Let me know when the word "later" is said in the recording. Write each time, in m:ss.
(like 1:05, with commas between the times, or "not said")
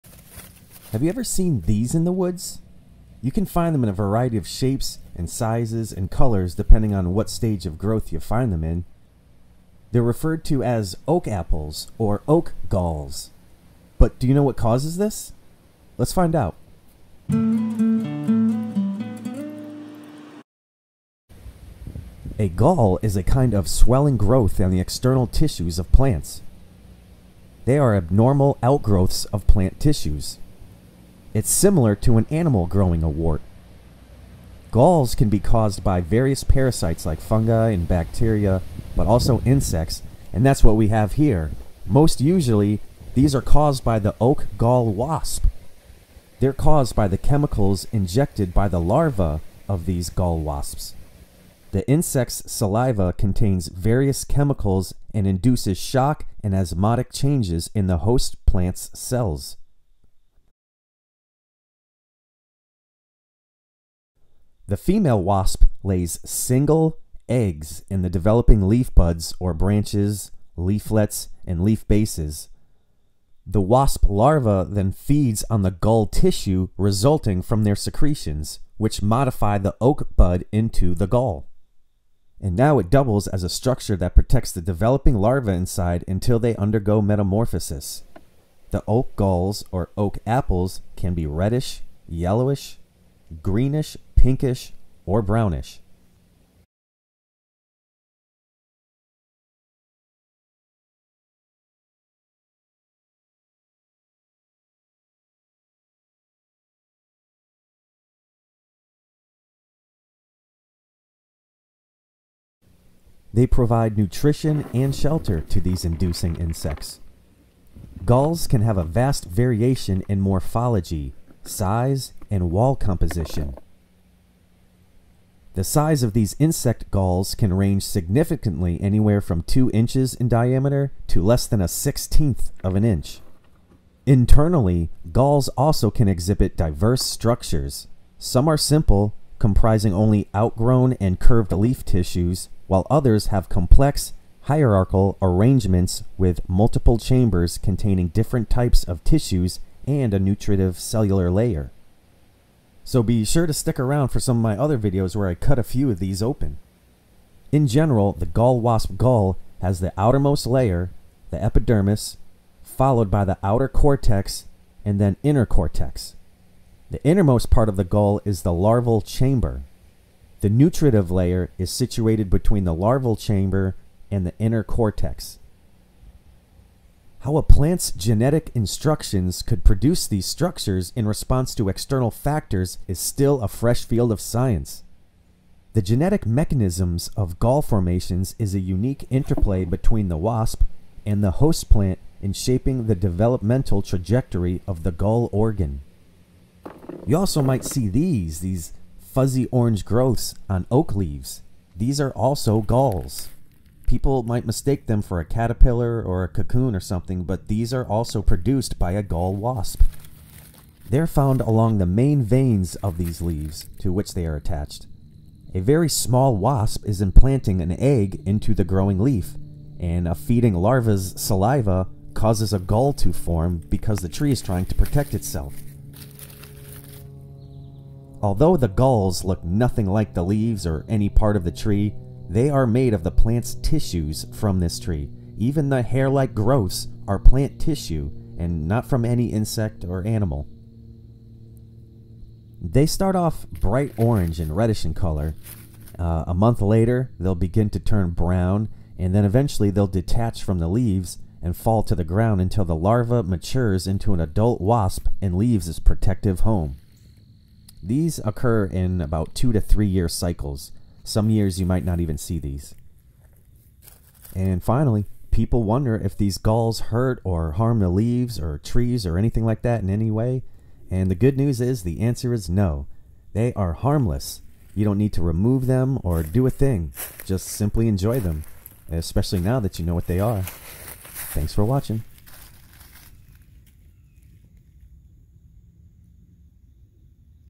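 4:06.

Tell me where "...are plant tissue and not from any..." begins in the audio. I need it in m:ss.
3:57.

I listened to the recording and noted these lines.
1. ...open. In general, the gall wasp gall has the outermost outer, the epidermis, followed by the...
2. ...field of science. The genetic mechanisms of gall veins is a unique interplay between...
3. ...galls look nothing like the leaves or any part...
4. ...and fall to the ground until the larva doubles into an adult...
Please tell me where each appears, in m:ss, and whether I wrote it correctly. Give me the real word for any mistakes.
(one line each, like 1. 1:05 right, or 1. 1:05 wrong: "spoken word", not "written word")
1. 2:36 wrong: "layer", not "outer"
2. 3:03 wrong: "formations", not "veins"
3. 3:48 right
4. 4:11 wrong: "matures", not "doubles".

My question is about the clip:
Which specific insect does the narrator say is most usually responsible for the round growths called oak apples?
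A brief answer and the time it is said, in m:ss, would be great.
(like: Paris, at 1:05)
oak gall wasp, at 0:44.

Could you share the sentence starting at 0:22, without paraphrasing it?
A gall is a kind of swelling growth on the external tissues of plants.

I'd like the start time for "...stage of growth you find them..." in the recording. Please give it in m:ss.
0:07.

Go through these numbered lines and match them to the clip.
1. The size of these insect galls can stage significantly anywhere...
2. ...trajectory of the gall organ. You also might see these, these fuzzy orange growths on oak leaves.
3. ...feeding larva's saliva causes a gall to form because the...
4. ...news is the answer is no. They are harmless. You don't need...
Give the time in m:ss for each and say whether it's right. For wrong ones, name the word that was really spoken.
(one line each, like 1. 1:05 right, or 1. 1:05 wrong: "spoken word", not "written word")
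1. 2:05 wrong: "range", not "stage"
2. 3:13 right
3. 3:40 right
4. 4:31 right.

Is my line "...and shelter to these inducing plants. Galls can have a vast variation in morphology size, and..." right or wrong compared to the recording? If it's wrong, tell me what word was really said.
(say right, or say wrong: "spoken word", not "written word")
wrong: "insects", not "plants".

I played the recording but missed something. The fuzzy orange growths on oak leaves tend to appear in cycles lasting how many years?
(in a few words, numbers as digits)
2 to 3 years.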